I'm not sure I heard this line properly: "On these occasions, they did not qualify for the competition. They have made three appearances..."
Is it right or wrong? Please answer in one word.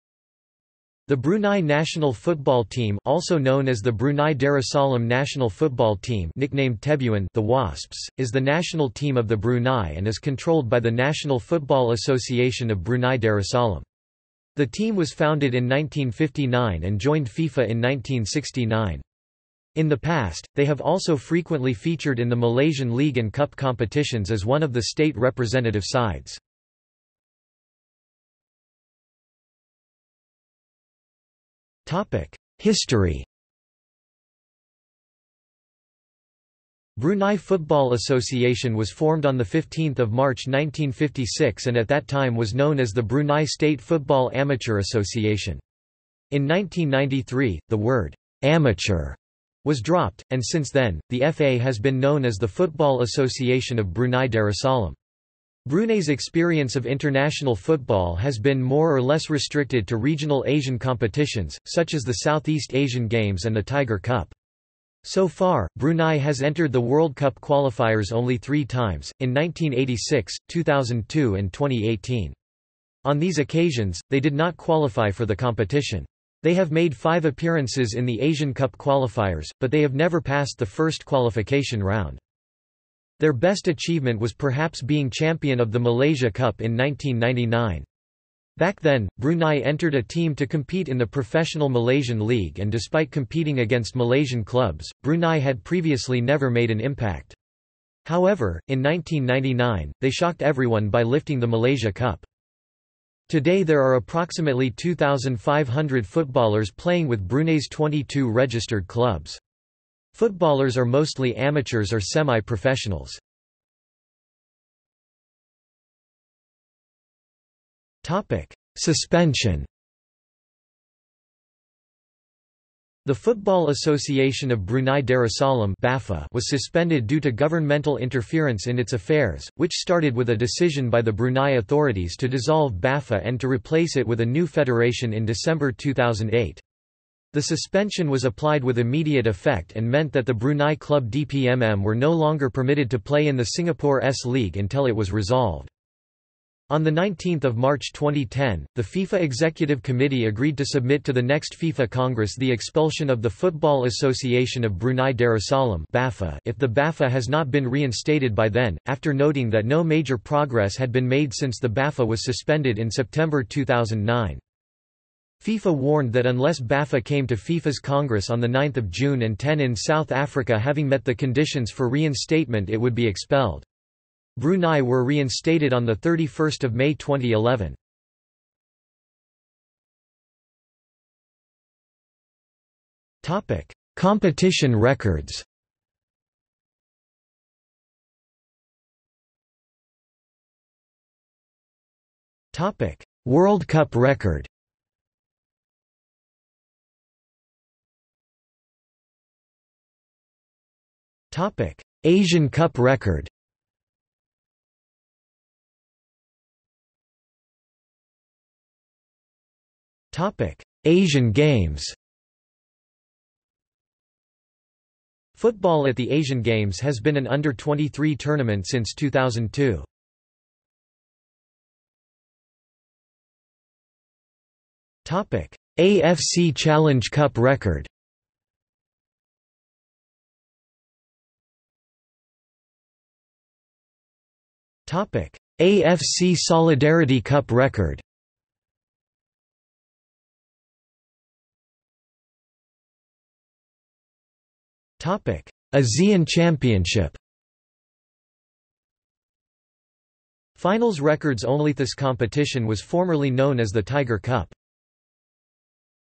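wrong.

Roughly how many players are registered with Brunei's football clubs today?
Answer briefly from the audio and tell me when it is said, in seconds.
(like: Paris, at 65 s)
2,500, at 104 s.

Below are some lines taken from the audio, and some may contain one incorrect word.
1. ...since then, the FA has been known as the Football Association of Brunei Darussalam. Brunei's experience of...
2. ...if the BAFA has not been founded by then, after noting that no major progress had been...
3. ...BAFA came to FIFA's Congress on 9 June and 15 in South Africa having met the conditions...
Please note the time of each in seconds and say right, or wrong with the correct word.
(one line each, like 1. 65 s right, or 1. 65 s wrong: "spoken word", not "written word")
1. 50 s right
2. 156 s wrong: "reinstated", not "founded"
3. 166 s wrong: "10", not "15".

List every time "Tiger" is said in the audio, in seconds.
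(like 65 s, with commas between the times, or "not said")
63 s, 253 s.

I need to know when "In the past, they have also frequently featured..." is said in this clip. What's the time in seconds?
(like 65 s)
19 s.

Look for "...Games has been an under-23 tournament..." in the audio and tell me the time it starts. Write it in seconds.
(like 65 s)
216 s.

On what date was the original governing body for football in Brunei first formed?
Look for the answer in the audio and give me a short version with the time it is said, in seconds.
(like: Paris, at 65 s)
15 March 1956, at 39 s.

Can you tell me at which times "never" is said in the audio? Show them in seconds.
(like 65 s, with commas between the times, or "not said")
79 s, 96 s.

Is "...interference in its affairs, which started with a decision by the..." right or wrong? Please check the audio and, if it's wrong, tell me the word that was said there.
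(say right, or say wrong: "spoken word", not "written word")
right.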